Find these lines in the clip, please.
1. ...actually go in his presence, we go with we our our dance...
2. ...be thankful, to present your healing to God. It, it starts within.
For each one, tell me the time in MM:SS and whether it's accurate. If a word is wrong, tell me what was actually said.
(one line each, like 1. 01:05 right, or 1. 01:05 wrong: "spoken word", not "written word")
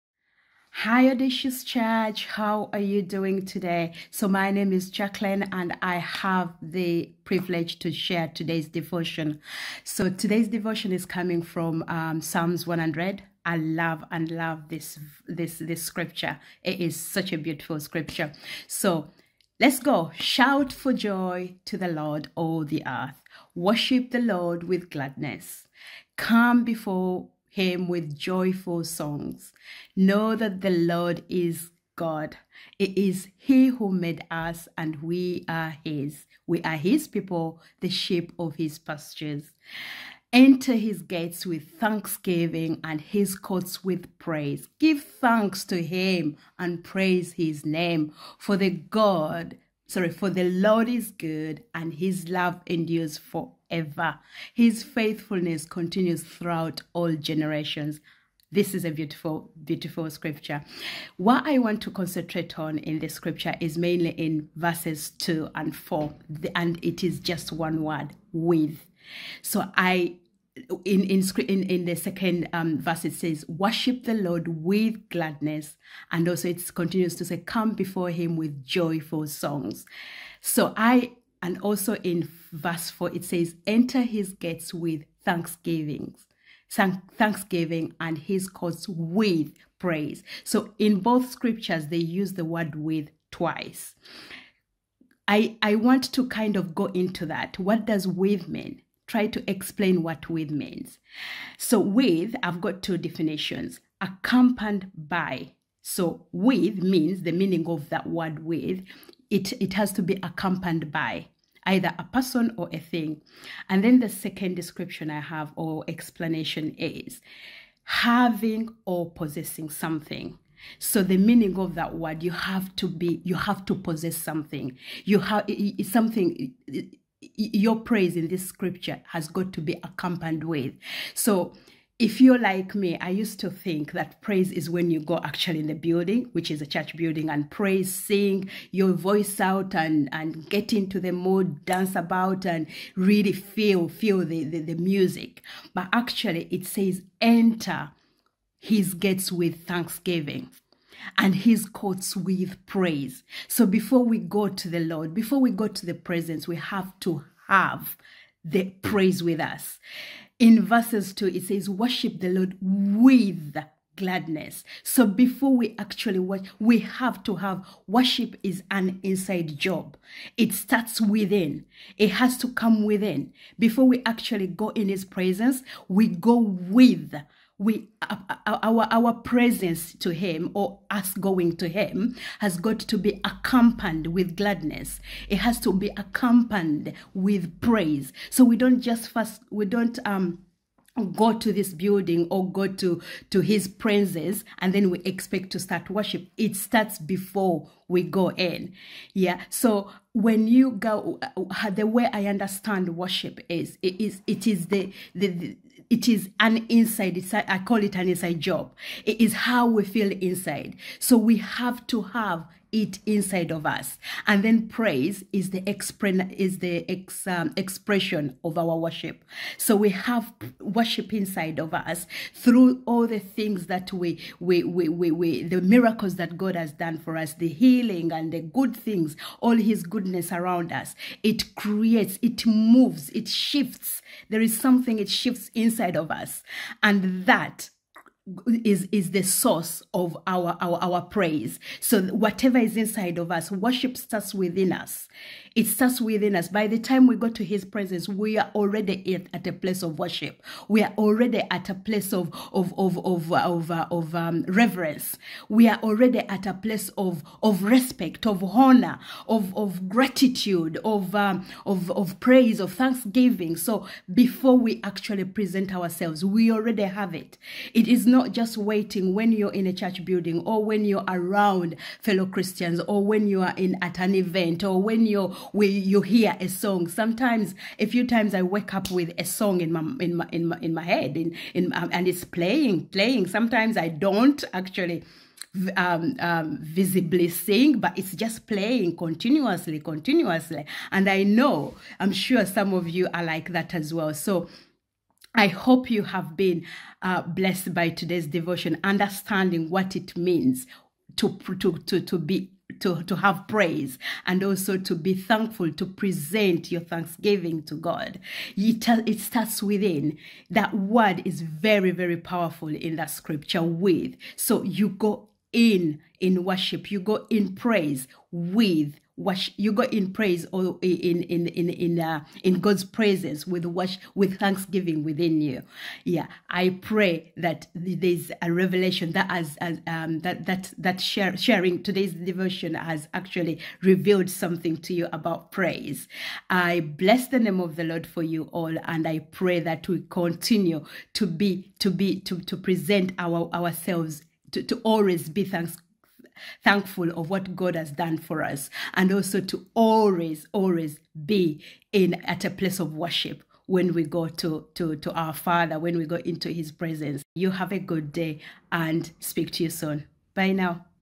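1. 02:54 wrong: "presence", not "dance"
2. 05:04 wrong: "thanksgiving", not "healing".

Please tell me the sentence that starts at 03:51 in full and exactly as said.
It creates, it moves, it shifts.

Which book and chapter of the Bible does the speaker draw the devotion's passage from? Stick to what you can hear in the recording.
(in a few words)
Psalms 100.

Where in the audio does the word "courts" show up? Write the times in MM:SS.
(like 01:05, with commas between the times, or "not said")
00:43, 01:28, 02:31.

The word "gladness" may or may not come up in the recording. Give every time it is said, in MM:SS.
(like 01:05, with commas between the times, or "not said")
00:24, 01:15, 02:43, 03:04.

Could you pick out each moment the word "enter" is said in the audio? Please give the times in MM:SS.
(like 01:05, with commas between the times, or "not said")
00:40, 01:23, 02:27.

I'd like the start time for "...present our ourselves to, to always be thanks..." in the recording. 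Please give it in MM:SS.
05:42.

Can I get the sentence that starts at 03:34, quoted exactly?
And then praise is the expre- is the ex, um, expression of our worship.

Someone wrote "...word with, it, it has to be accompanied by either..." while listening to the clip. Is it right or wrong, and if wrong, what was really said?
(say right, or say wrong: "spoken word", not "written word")
right.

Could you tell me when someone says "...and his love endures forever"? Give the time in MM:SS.
00:51.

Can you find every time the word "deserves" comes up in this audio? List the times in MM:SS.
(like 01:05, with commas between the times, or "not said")
not said.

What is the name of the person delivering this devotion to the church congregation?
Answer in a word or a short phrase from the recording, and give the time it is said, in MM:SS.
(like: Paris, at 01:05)
Jacqueline, at 00:04.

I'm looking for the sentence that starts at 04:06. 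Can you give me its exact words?
By the time we go to His presence, we are already at, at a place of worship.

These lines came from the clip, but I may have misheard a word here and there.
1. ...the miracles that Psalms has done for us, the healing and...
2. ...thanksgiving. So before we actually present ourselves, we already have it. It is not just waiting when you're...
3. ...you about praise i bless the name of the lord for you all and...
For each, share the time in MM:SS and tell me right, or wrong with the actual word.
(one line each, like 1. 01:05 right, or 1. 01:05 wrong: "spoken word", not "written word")
1. 03:45 wrong: "God", not "Psalms"
2. 04:22 right
3. 05:34 right.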